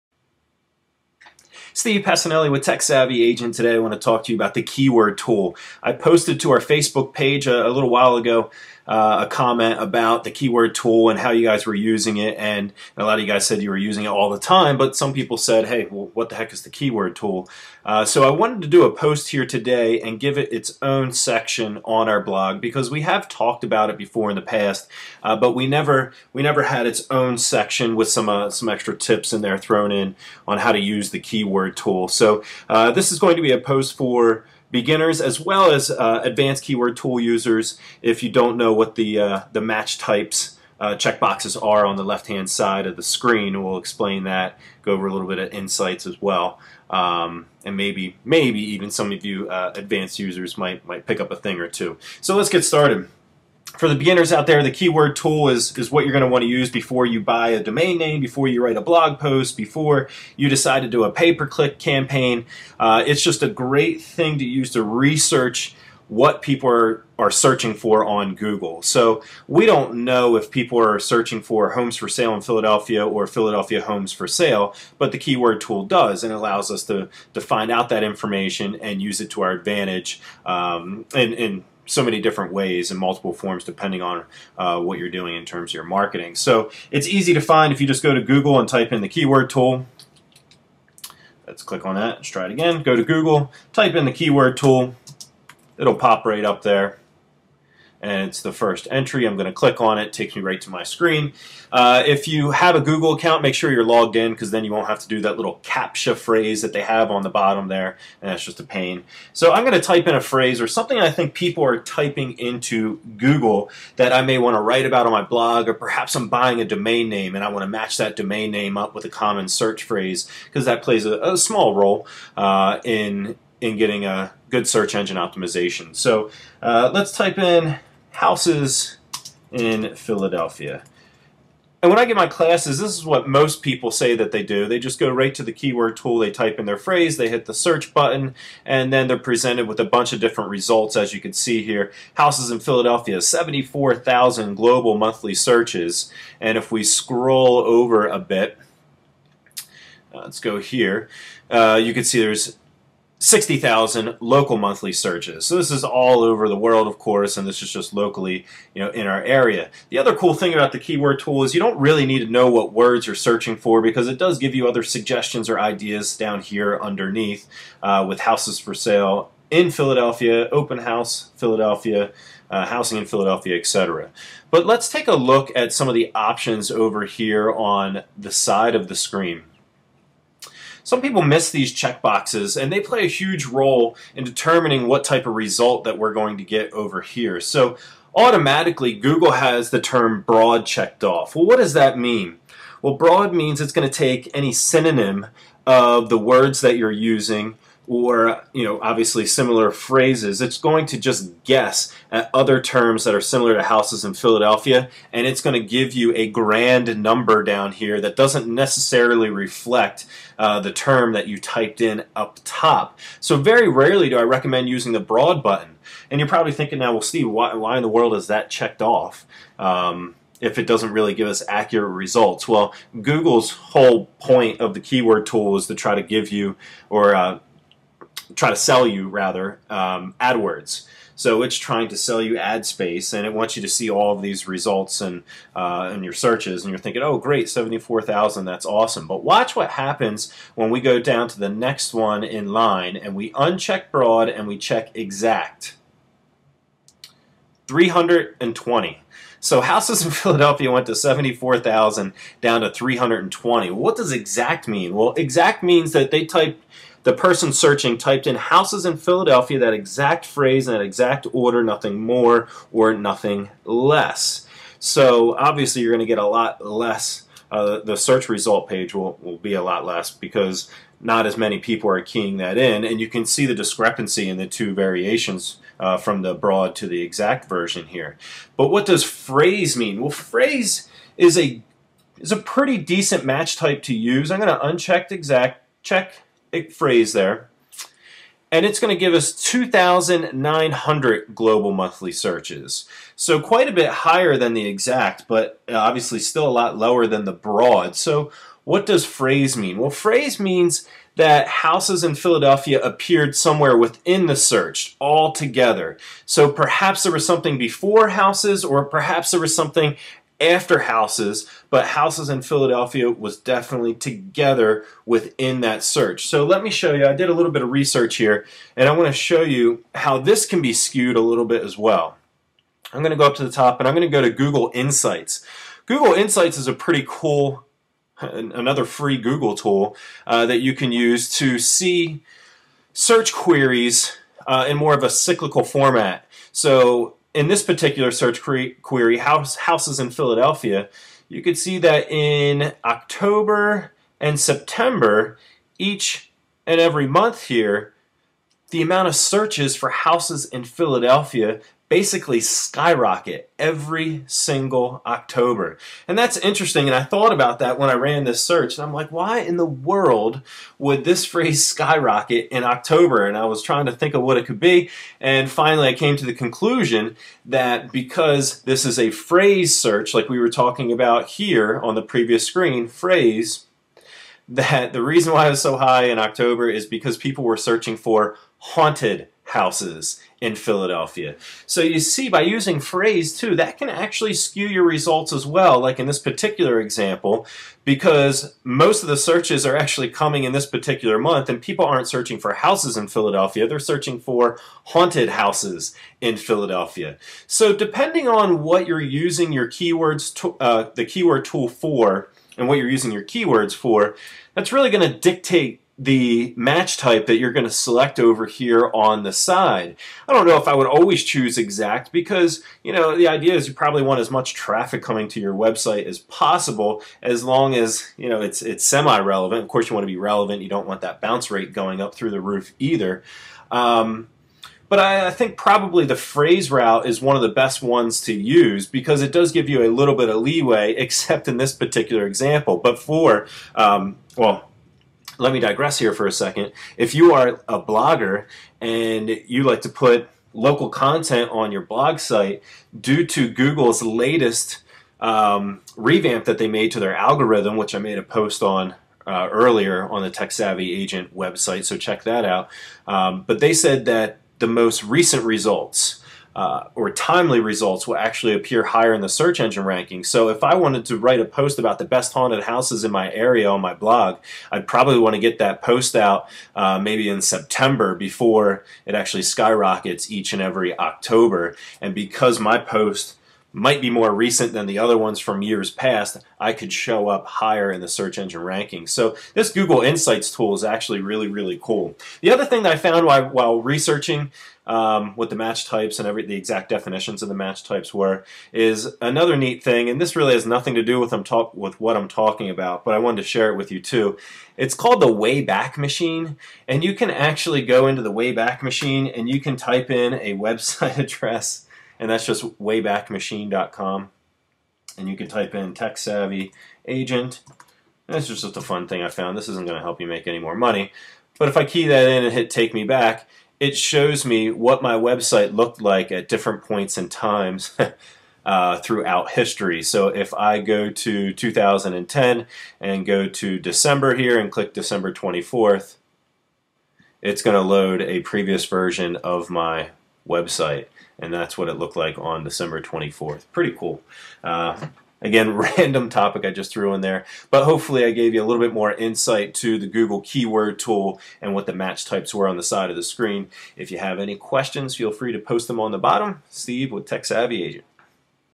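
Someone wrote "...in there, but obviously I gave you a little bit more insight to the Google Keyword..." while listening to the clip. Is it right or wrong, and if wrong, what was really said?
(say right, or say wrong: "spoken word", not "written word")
wrong: "hopefully", not "obviously".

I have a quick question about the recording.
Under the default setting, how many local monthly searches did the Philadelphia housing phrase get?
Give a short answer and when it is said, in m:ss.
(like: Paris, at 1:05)
60,000, at 2:33.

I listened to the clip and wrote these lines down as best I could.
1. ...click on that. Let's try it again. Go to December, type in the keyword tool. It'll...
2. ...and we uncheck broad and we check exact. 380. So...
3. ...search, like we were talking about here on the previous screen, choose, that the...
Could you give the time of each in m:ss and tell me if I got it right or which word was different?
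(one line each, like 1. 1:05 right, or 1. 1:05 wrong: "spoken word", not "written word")
1. 1:31 wrong: "Google", not "December"
2. 4:02 wrong: "320", not "380"
3. 6:09 wrong: "phrase", not "choose".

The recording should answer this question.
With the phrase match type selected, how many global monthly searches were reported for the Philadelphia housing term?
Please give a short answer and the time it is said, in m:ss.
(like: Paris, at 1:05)
2,900, at 4:49.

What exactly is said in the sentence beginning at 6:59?
Of course, you want to be relevant.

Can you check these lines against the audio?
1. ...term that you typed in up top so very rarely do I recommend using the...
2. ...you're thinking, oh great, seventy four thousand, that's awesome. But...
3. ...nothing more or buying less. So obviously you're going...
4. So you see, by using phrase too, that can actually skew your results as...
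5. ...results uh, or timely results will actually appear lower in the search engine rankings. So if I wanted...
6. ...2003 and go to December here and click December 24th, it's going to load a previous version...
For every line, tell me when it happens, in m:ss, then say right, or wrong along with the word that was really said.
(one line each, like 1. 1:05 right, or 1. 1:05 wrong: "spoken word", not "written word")
1. 3:30 right
2. 3:56 right
3. 4:21 wrong: "nothing", not "buying"
4. 6:21 right
5. 7:35 wrong: "higher", not "lower"
6. 8:41 wrong: "2010", not "2003".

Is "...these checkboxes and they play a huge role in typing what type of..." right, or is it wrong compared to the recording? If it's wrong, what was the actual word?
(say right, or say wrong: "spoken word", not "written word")
wrong: "determining", not "typing".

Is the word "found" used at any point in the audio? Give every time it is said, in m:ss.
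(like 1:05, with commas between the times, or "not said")
8:02, 8:29.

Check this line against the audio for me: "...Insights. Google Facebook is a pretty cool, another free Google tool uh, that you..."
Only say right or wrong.
wrong.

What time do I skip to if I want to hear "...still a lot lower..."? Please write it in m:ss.
4:56.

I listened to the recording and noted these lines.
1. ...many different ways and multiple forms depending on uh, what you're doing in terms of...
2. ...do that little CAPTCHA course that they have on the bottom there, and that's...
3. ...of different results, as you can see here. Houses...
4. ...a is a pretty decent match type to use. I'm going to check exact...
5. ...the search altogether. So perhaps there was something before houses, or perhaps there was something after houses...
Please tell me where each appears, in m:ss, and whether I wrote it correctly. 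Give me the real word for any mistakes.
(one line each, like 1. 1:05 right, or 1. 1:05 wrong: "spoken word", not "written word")
1. 1:22 right
2. 1:45 wrong: "phrase", not "course"
3. 2:20 right
4. 4:41 wrong: "uncheck", not "check"
5. 5:04 right.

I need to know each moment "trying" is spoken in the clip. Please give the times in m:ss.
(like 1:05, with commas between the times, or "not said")
3:51, 6:03.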